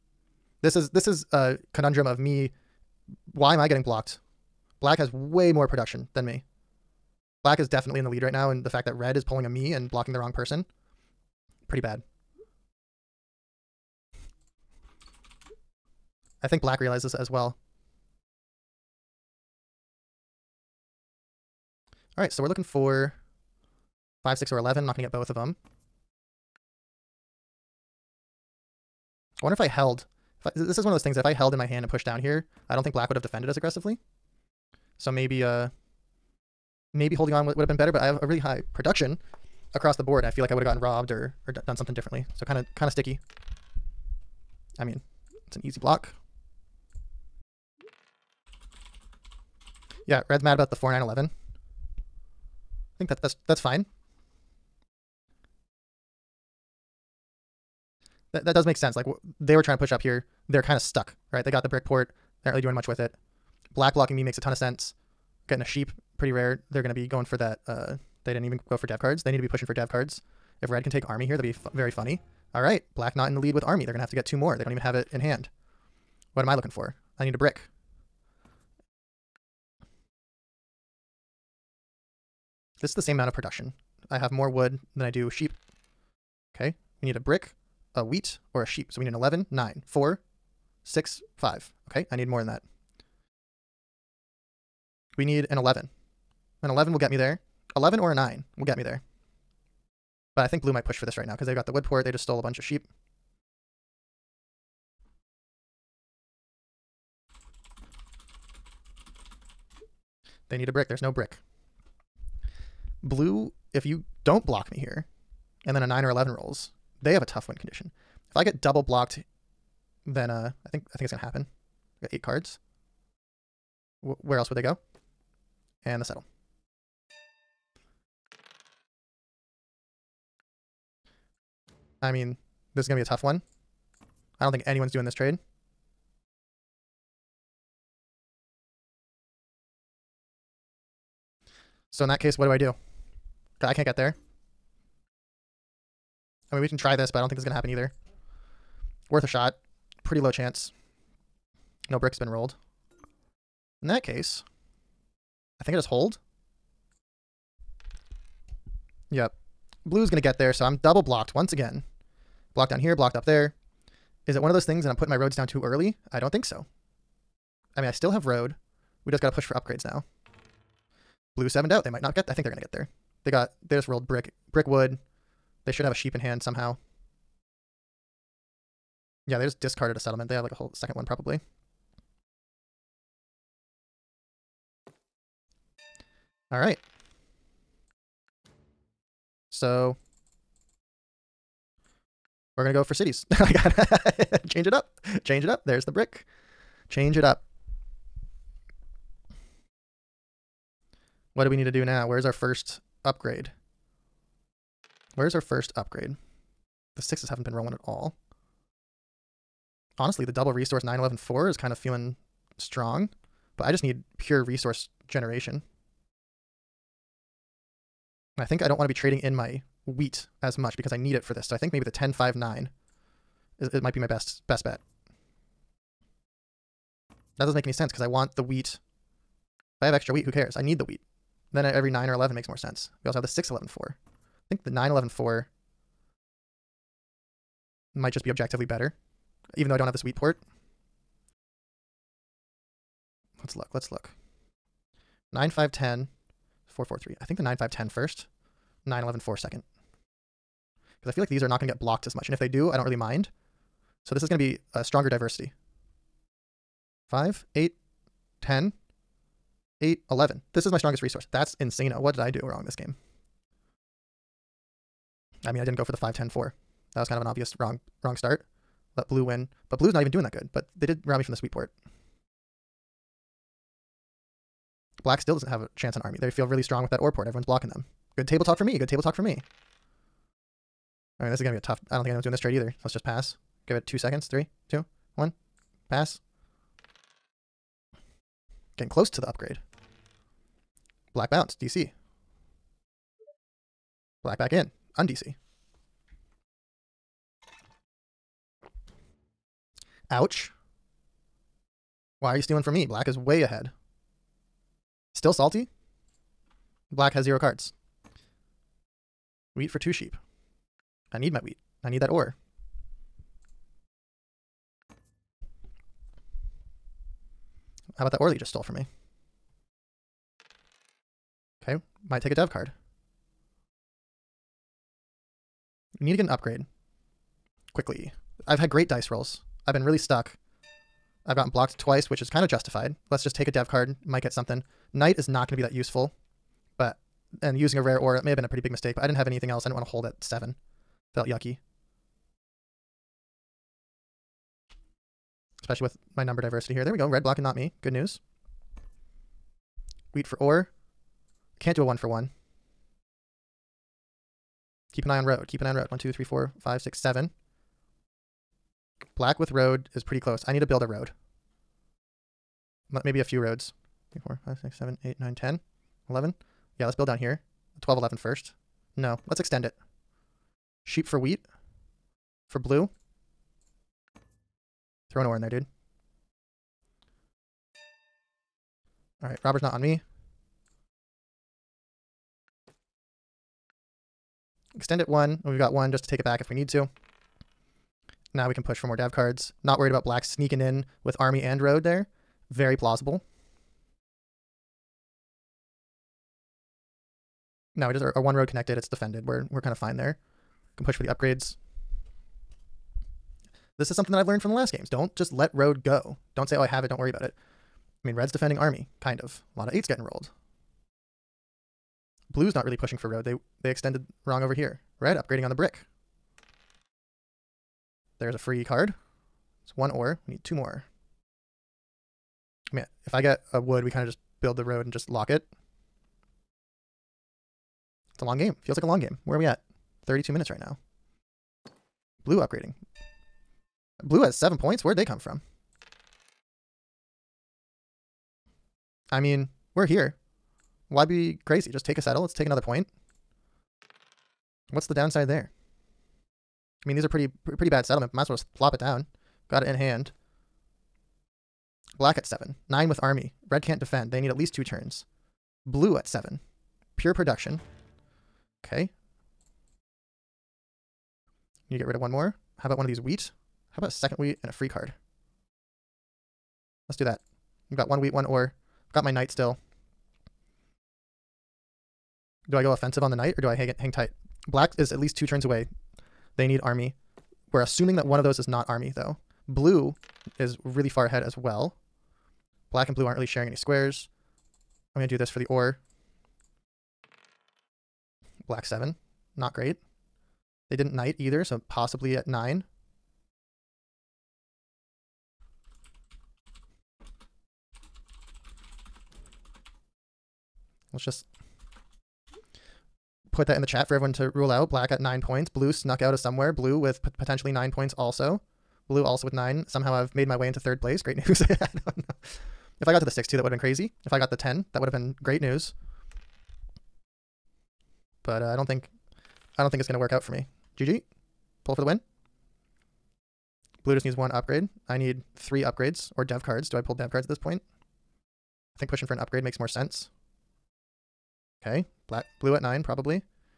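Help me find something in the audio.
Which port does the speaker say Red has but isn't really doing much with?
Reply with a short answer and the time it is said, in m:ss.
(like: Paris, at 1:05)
brick port, at 1:01.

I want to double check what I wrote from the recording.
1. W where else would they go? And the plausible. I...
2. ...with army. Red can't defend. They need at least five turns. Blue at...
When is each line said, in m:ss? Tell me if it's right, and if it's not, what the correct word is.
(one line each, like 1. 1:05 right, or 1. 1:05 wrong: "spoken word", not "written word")
1. 2:04 wrong: "settle", not "plausible"
2. 7:32 wrong: "two", not "five".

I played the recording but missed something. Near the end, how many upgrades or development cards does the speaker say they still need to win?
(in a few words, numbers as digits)
3.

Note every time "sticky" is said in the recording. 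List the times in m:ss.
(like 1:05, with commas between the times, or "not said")
0:42.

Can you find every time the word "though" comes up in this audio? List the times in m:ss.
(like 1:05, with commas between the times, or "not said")
3:59, 7:58.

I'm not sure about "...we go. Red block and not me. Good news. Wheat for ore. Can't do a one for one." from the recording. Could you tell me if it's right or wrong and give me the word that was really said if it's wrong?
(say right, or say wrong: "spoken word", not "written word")
right.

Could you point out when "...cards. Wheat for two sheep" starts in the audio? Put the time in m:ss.
5:07.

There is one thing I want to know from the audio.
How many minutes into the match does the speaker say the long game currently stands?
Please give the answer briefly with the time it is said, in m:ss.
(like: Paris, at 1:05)
32, at 7:10.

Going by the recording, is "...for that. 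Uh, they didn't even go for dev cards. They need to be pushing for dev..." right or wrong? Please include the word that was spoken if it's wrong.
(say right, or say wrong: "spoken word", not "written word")
right.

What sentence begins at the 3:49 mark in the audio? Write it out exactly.
If I have extra wheat, who cares?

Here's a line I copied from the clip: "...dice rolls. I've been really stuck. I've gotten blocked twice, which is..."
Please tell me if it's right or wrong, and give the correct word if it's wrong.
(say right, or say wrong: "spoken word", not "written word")
right.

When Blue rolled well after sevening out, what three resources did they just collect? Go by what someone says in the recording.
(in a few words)
brick brick wood.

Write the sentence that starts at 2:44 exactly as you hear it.
Is it one of those things that I'm putting my roads down too early?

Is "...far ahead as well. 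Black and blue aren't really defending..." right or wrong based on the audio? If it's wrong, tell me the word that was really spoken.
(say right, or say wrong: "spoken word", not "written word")
wrong: "sharing", not "defending".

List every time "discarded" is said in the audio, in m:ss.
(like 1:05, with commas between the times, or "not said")
2:59.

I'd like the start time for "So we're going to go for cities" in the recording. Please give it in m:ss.
3:09.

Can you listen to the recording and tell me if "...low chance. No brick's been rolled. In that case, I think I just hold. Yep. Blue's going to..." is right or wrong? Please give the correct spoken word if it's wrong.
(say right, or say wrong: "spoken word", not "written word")
right.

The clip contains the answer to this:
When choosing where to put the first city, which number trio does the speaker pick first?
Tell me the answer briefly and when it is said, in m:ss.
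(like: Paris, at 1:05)
9, 5, 10, at 4:07.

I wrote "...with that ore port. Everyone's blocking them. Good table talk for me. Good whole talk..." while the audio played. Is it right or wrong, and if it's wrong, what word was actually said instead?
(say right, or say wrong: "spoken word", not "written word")
wrong: "table", not "whole".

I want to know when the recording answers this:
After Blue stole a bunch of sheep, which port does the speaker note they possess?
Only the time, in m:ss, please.
1:41.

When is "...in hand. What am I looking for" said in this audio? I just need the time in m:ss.
1:15.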